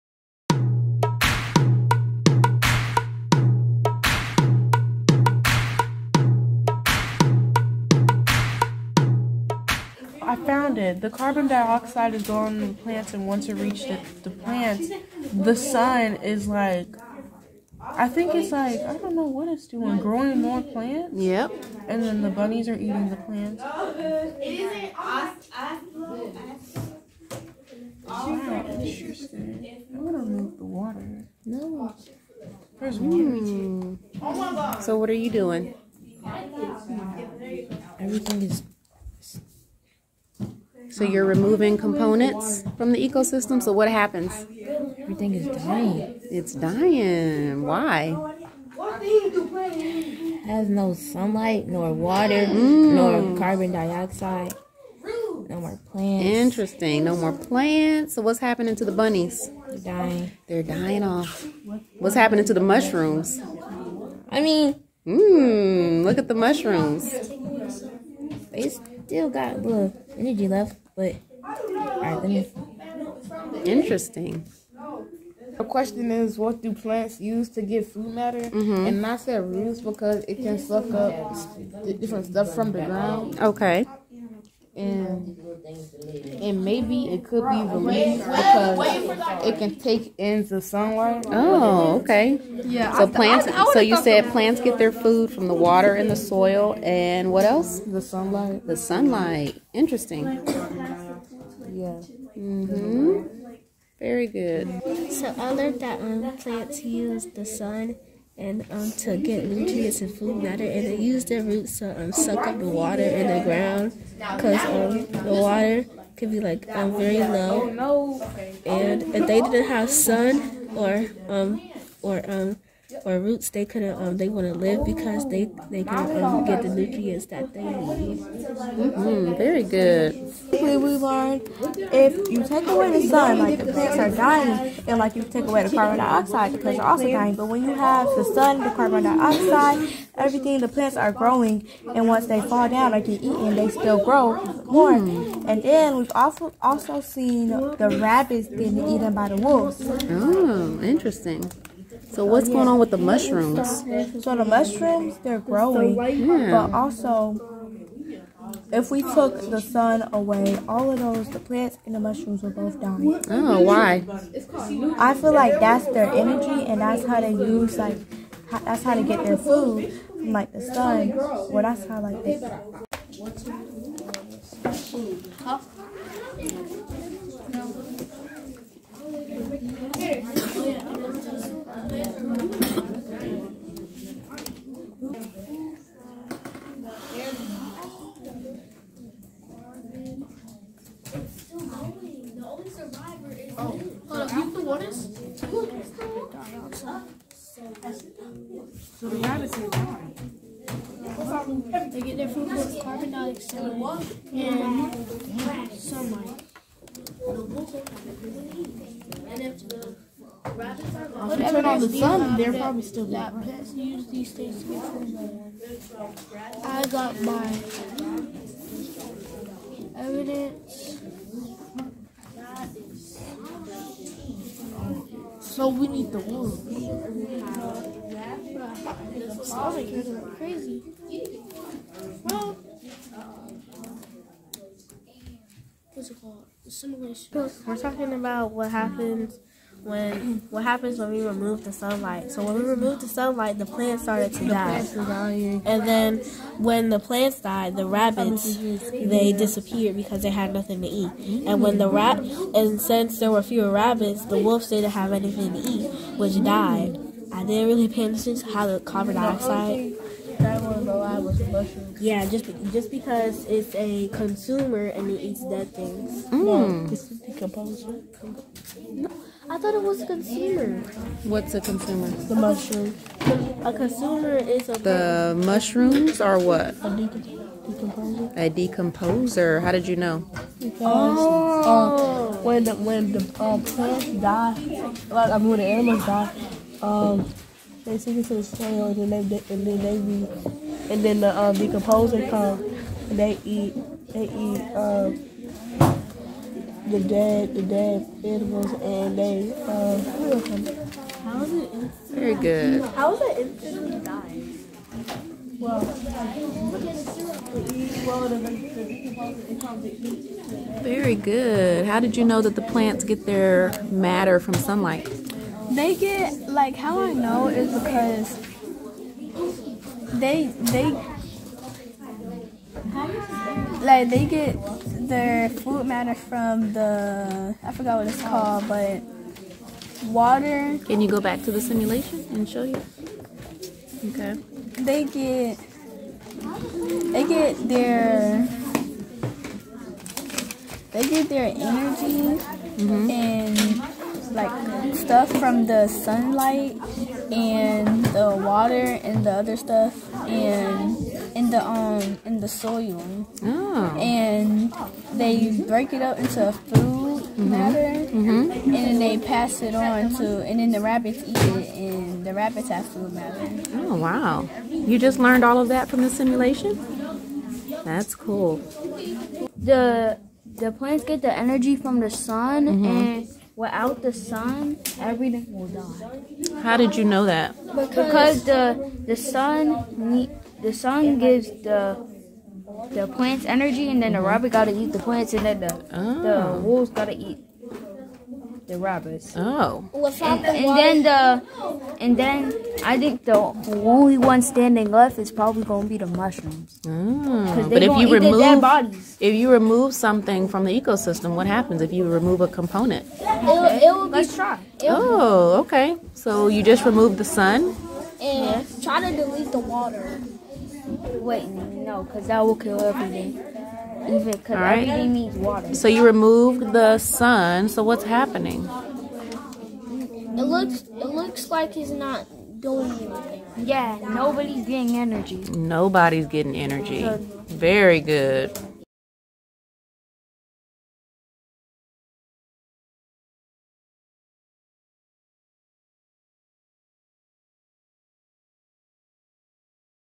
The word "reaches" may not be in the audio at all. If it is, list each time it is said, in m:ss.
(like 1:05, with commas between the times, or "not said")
0:13.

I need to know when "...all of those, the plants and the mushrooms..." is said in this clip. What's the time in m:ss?
2:40.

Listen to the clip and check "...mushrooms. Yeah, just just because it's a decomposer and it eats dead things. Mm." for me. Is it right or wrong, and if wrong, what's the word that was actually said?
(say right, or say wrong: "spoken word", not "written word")
wrong: "consumer", not "decomposer".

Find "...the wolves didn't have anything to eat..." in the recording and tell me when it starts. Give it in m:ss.
4:14.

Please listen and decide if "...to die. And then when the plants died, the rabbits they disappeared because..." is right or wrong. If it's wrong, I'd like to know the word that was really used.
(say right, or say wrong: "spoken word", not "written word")
right.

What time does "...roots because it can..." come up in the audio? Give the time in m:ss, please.
1:19.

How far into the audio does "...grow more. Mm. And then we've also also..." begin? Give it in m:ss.
2:24.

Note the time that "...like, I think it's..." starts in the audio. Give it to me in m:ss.
0:16.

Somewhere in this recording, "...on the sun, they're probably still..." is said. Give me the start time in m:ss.
3:31.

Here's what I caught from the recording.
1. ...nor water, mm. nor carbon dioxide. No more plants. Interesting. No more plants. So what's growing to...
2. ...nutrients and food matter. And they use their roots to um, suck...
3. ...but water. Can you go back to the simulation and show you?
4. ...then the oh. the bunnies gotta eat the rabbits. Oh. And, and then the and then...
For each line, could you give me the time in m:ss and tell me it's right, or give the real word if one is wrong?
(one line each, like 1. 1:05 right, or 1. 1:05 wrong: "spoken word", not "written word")
1. 0:51 wrong: "happening", not "growing"
2. 1:49 right
3. 5:28 right
4. 6:25 wrong: "wolves", not "bunnies".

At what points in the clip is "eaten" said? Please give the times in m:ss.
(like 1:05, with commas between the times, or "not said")
2:23, 2:28.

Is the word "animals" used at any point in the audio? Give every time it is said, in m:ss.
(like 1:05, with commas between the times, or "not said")
4:45, 4:58.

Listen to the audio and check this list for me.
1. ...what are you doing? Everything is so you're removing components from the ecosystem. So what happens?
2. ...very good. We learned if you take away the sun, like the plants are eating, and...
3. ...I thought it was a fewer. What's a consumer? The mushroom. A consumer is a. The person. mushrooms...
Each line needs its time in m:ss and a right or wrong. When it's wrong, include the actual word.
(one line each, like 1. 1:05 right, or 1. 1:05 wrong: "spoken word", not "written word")
1. 0:34 right
2. 2:09 wrong: "dying", not "eating"
3. 4:29 wrong: "consumer", not "fewer".